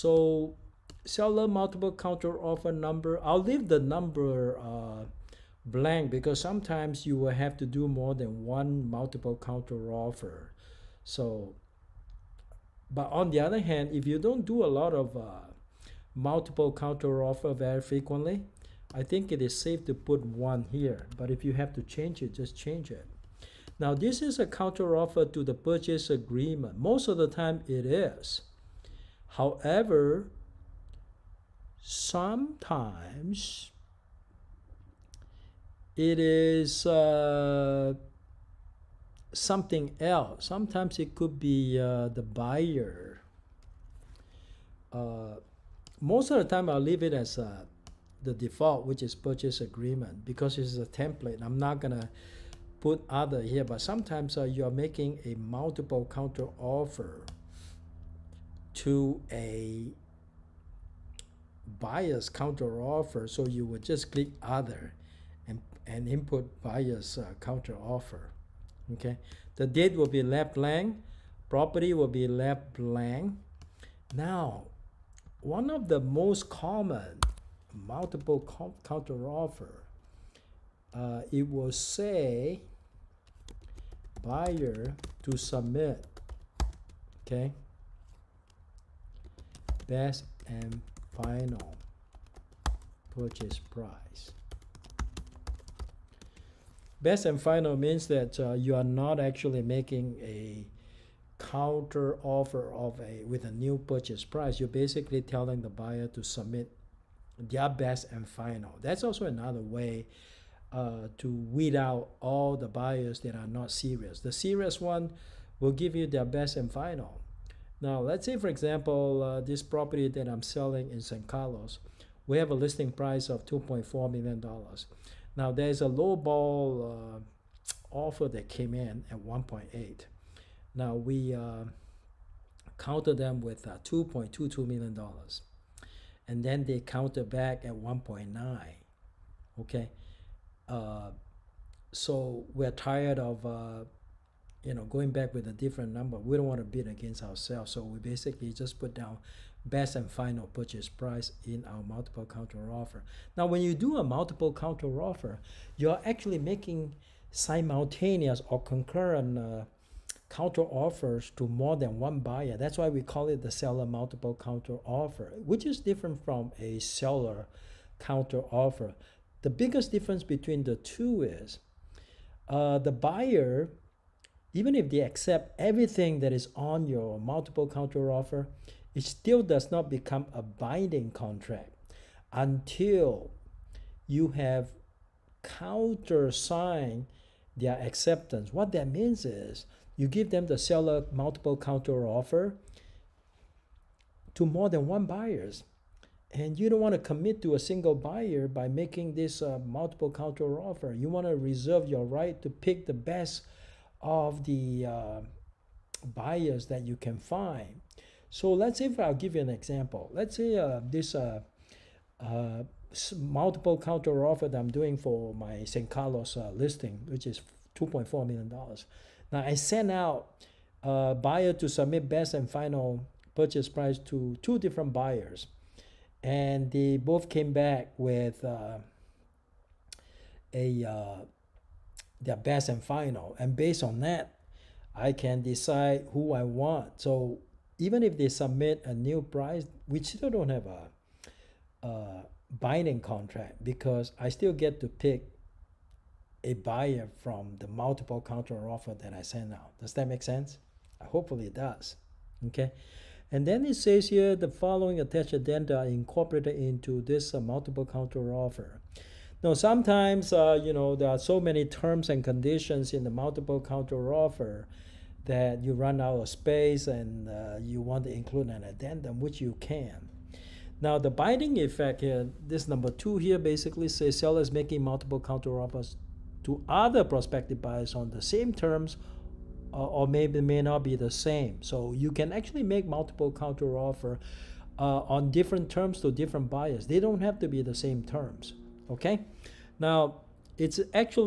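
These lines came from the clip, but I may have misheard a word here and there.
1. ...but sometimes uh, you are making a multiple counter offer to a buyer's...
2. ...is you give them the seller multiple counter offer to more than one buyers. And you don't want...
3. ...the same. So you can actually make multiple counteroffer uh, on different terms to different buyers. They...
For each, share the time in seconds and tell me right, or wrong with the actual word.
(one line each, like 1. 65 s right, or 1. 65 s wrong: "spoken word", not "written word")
1. 53 s right
2. 189 s right
3. 280 s right.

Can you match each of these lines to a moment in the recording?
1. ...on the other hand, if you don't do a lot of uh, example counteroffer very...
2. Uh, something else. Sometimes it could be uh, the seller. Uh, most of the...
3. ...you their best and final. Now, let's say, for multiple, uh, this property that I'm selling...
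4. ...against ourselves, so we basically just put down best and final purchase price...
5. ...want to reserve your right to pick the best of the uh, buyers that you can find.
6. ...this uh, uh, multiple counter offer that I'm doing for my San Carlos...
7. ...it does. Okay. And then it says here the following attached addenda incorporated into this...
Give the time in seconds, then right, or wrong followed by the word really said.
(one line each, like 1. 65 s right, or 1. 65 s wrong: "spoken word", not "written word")
1. 13 s wrong: "multiple", not "example"
2. 36 s wrong: "buyer", not "seller"
3. 115 s wrong: "example", not "multiple"
4. 146 s right
5. 201 s right
6. 210 s right
7. 251 s right.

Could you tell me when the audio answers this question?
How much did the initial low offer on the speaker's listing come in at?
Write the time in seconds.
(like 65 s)
129 s.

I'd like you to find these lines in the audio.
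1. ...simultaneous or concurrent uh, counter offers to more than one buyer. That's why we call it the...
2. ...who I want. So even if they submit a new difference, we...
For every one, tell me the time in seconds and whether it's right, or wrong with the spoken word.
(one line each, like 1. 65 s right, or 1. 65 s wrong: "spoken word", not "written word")
1. 157 s right
2. 236 s wrong: "price", not "difference".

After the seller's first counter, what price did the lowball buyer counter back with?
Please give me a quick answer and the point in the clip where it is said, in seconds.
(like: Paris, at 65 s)
1.9 million, at 137 s.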